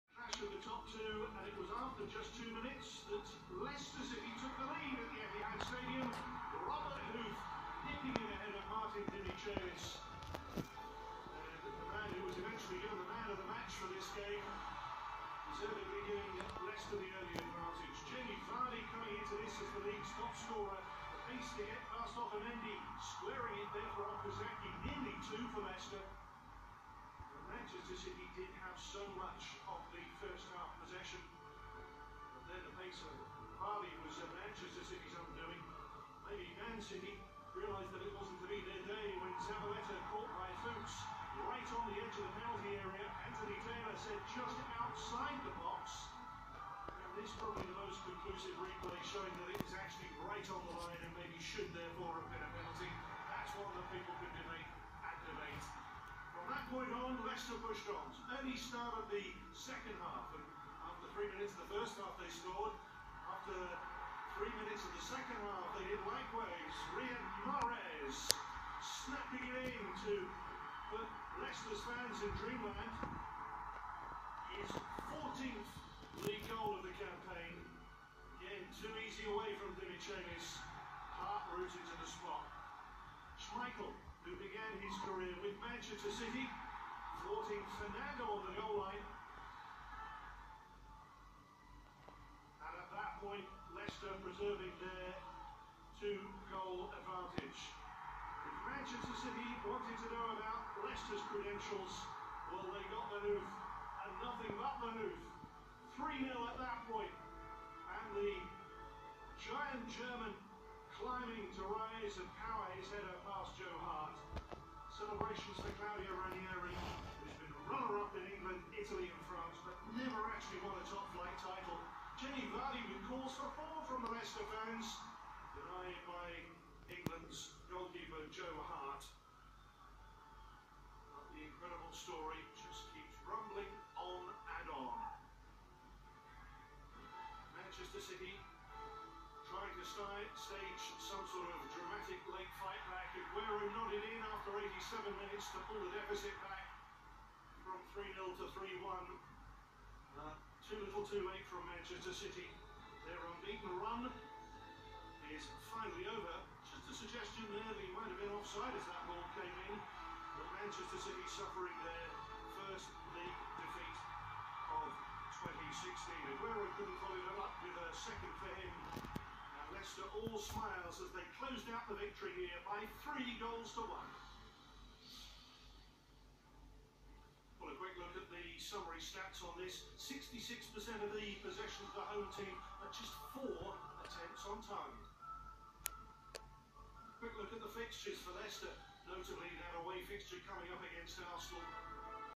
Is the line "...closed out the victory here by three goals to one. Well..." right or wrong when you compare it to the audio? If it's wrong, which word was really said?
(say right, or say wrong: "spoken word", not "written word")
right.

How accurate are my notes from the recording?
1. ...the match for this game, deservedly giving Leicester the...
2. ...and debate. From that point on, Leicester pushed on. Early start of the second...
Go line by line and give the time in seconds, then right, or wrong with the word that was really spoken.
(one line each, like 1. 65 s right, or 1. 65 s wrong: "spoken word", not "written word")
1. 13 s right
2. 54 s right.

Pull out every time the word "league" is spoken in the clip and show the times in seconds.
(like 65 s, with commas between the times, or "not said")
19 s, 76 s, 163 s.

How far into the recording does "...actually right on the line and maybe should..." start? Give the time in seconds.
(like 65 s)
49 s.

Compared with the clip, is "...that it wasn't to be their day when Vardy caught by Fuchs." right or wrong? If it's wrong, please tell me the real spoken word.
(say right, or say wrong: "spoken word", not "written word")
wrong: "Zabaleta", not "Vardy".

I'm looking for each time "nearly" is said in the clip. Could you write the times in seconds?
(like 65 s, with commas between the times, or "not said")
24 s.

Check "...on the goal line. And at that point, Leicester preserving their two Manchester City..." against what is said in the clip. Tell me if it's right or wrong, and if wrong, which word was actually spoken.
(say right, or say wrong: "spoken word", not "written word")
right.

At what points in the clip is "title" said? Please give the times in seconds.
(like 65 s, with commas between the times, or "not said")
121 s.